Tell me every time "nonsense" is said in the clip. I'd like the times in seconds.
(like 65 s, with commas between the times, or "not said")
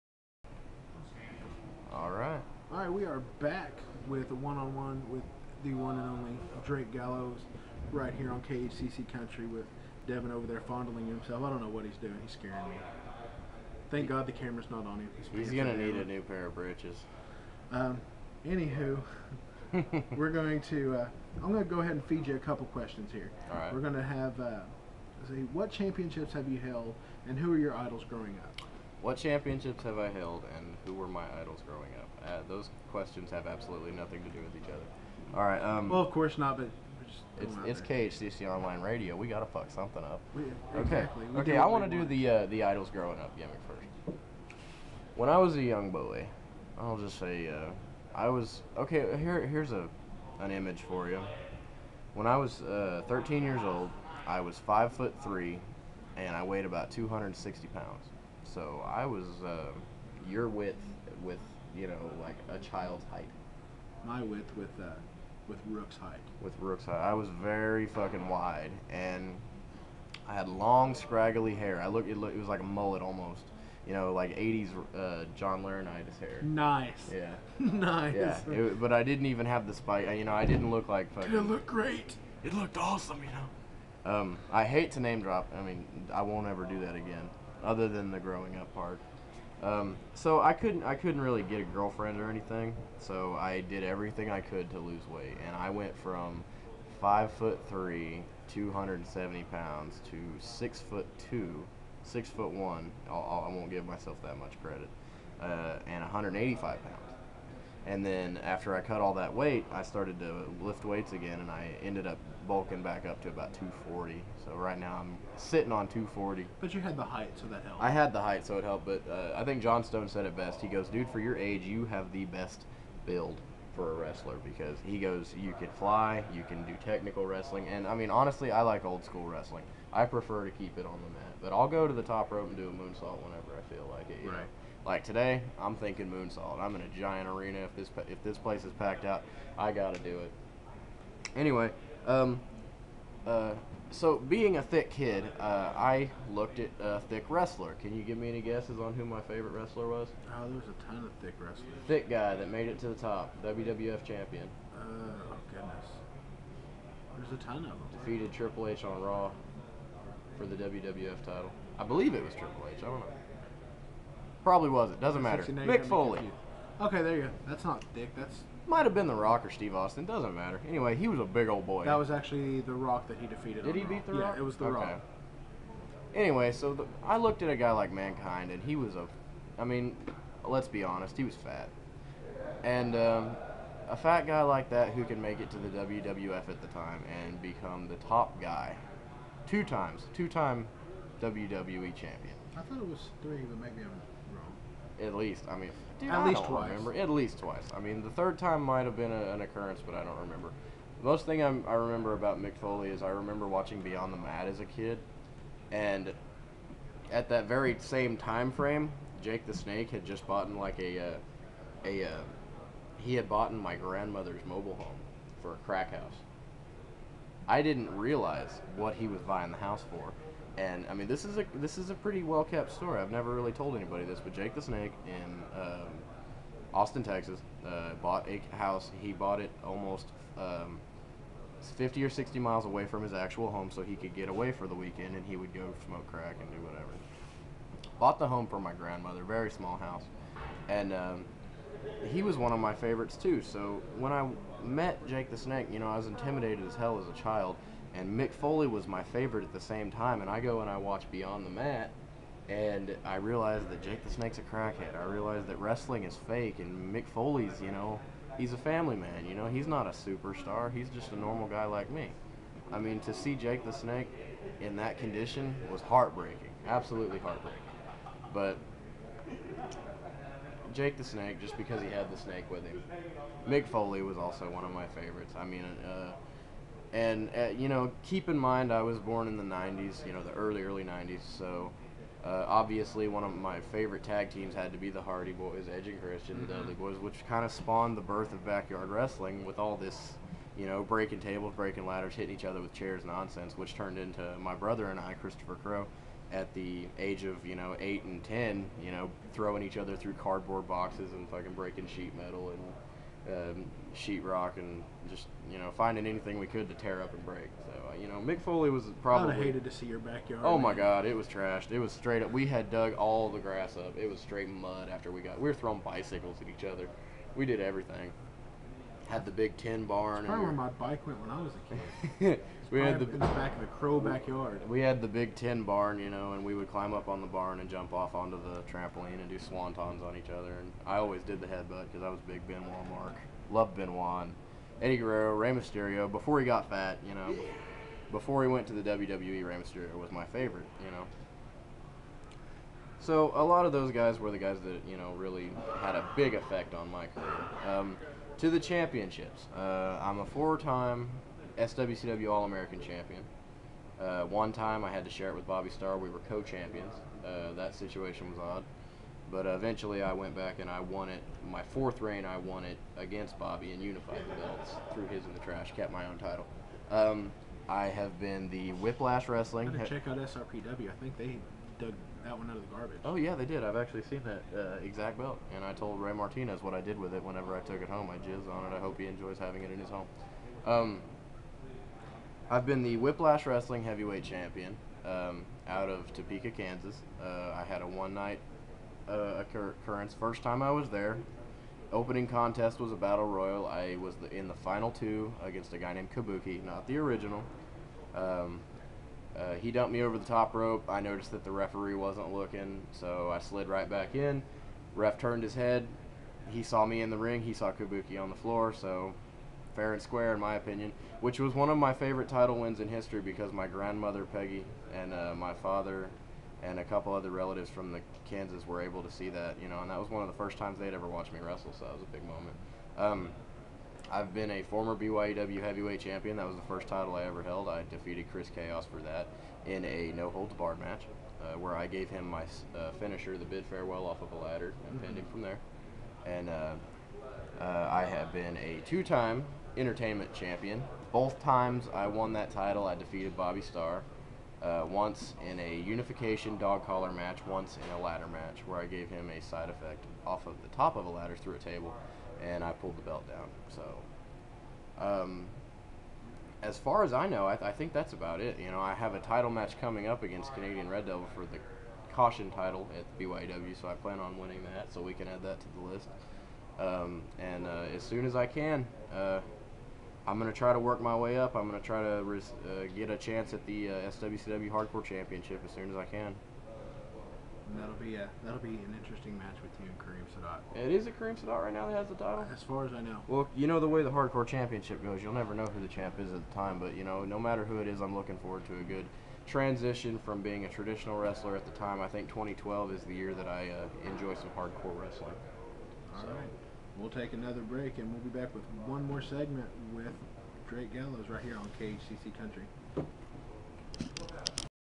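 293 s.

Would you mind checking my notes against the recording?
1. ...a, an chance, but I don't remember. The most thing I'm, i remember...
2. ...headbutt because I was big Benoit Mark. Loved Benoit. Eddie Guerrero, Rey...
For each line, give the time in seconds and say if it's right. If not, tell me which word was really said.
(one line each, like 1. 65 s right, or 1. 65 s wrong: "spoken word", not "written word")
1. 199 s wrong: "occurrence", not "chance"
2. 331 s right.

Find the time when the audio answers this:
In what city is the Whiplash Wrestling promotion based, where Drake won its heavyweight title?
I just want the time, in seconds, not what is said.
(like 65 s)
386 s.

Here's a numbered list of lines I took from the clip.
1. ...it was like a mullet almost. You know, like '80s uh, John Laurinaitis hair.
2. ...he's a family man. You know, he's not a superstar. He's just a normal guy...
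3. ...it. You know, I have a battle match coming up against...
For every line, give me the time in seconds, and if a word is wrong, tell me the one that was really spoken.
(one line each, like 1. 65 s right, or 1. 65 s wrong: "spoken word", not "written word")
1. 72 s right
2. 258 s right
3. 458 s wrong: "title", not "battle".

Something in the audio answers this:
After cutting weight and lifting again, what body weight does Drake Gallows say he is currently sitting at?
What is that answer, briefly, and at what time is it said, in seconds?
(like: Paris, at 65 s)
240, at 114 s.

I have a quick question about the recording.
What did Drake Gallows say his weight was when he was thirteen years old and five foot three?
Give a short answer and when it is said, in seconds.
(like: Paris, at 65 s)
260 pounds, at 56 s.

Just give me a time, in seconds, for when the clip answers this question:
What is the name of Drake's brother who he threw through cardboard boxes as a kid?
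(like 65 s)
295 s.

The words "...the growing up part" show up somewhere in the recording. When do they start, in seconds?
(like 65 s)
88 s.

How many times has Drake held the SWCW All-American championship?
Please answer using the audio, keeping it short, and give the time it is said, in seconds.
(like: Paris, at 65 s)
4, at 350 s.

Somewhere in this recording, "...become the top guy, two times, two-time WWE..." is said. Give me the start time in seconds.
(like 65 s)
187 s.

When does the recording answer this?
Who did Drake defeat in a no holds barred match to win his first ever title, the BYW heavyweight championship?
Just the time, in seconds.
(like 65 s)
428 s.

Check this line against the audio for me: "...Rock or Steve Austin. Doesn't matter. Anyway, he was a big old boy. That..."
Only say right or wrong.
right.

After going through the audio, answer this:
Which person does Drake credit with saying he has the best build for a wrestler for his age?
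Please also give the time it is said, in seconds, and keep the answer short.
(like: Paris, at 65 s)
John Stone, at 119 s.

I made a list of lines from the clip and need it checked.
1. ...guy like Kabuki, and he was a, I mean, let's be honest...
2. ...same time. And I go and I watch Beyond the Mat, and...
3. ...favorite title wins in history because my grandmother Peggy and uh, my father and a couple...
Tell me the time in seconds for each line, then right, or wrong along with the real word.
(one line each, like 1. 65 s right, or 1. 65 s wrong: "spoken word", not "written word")
1. 177 s wrong: "Mankind", not "Kabuki"
2. 249 s right
3. 411 s right.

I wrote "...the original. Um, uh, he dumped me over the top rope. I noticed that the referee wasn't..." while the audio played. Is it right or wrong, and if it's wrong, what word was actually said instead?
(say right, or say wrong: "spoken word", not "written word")
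right.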